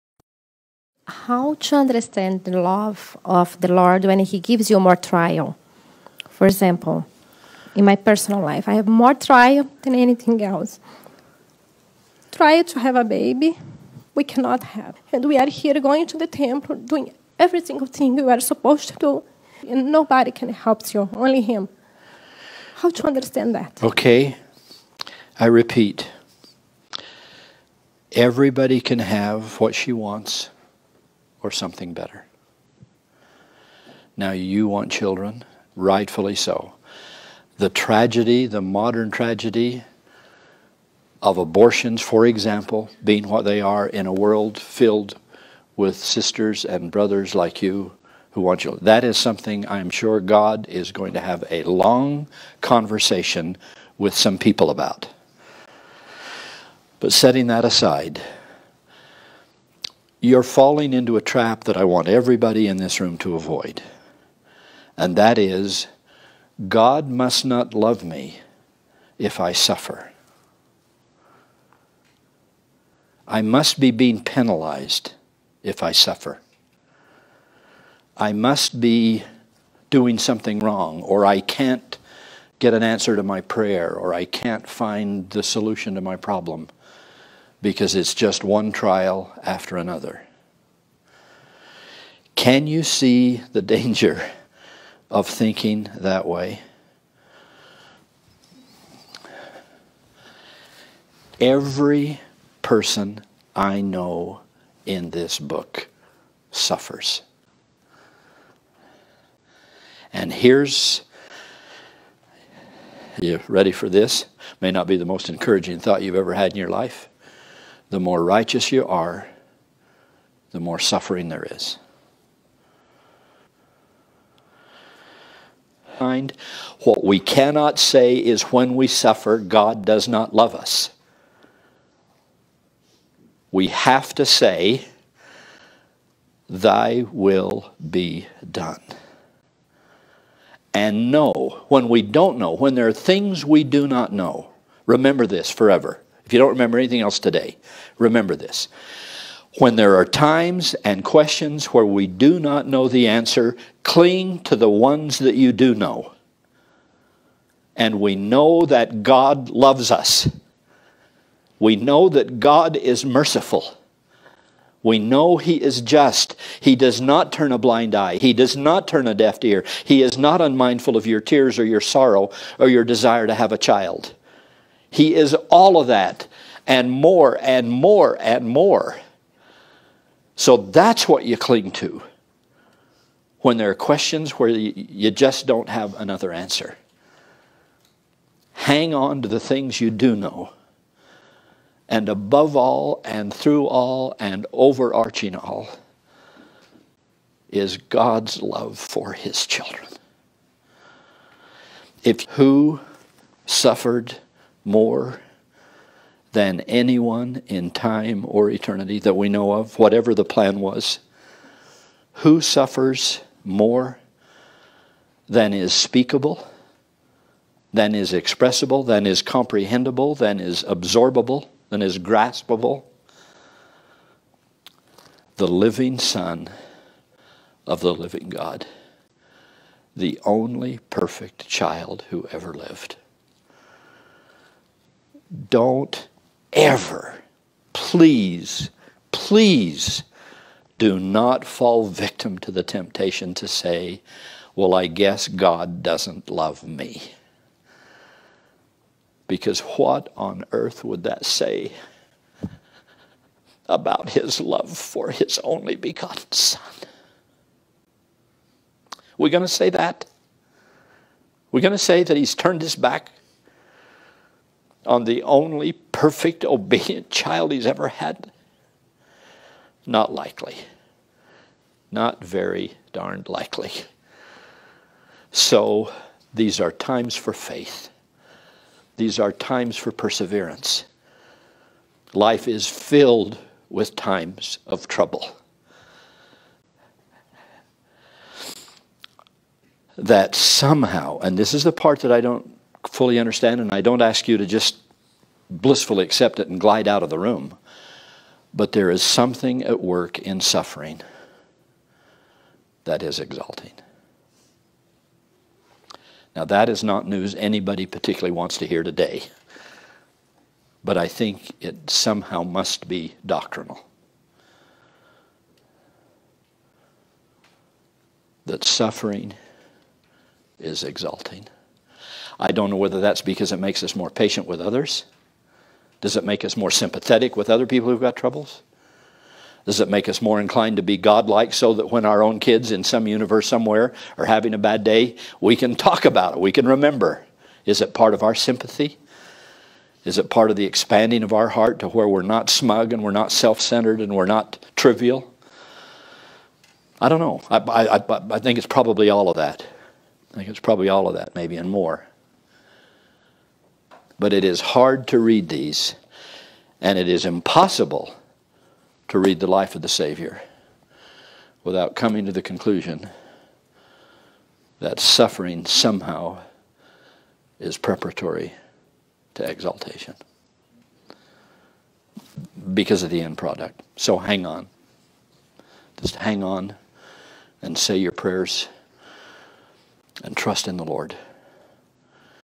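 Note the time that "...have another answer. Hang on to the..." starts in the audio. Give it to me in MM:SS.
03:05.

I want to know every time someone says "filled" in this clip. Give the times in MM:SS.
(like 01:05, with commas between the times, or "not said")
00:44, 04:42.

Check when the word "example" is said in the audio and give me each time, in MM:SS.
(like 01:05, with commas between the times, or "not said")
00:06, 00:42.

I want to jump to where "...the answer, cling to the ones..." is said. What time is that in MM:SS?
02:32.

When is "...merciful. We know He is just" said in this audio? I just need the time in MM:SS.
02:43.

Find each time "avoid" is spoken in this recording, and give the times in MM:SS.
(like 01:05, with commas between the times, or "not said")
01:03.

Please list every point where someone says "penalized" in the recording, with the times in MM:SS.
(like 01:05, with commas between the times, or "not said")
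01:14.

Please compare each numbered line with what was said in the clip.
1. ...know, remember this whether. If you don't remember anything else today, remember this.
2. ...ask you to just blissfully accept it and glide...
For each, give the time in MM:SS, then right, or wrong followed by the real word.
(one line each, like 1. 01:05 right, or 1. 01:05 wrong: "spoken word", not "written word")
1. 02:24 wrong: "forever", not "whether"
2. 04:53 right.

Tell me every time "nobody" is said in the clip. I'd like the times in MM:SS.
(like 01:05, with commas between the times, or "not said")
00:19.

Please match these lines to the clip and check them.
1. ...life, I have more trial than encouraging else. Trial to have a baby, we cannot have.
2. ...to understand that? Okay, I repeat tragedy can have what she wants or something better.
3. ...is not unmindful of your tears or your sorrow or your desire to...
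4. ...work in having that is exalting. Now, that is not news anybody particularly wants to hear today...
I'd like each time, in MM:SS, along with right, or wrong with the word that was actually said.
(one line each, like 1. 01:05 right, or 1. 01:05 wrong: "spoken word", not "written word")
1. 00:08 wrong: "anything", not "encouraging"
2. 00:22 wrong: "everybody", not "tragedy"
3. 02:50 right
4. 04:59 wrong: "suffering", not "having".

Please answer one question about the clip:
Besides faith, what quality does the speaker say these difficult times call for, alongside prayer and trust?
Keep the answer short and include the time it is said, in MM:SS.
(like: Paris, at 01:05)
perseverance, at 04:39.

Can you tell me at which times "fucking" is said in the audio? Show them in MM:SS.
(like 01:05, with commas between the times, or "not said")
not said.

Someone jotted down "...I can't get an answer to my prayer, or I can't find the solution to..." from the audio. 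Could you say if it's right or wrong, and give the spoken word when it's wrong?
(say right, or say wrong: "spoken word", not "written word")
right.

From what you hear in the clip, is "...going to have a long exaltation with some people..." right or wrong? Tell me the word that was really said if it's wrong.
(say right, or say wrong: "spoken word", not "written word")
wrong: "conversation", not "exaltation".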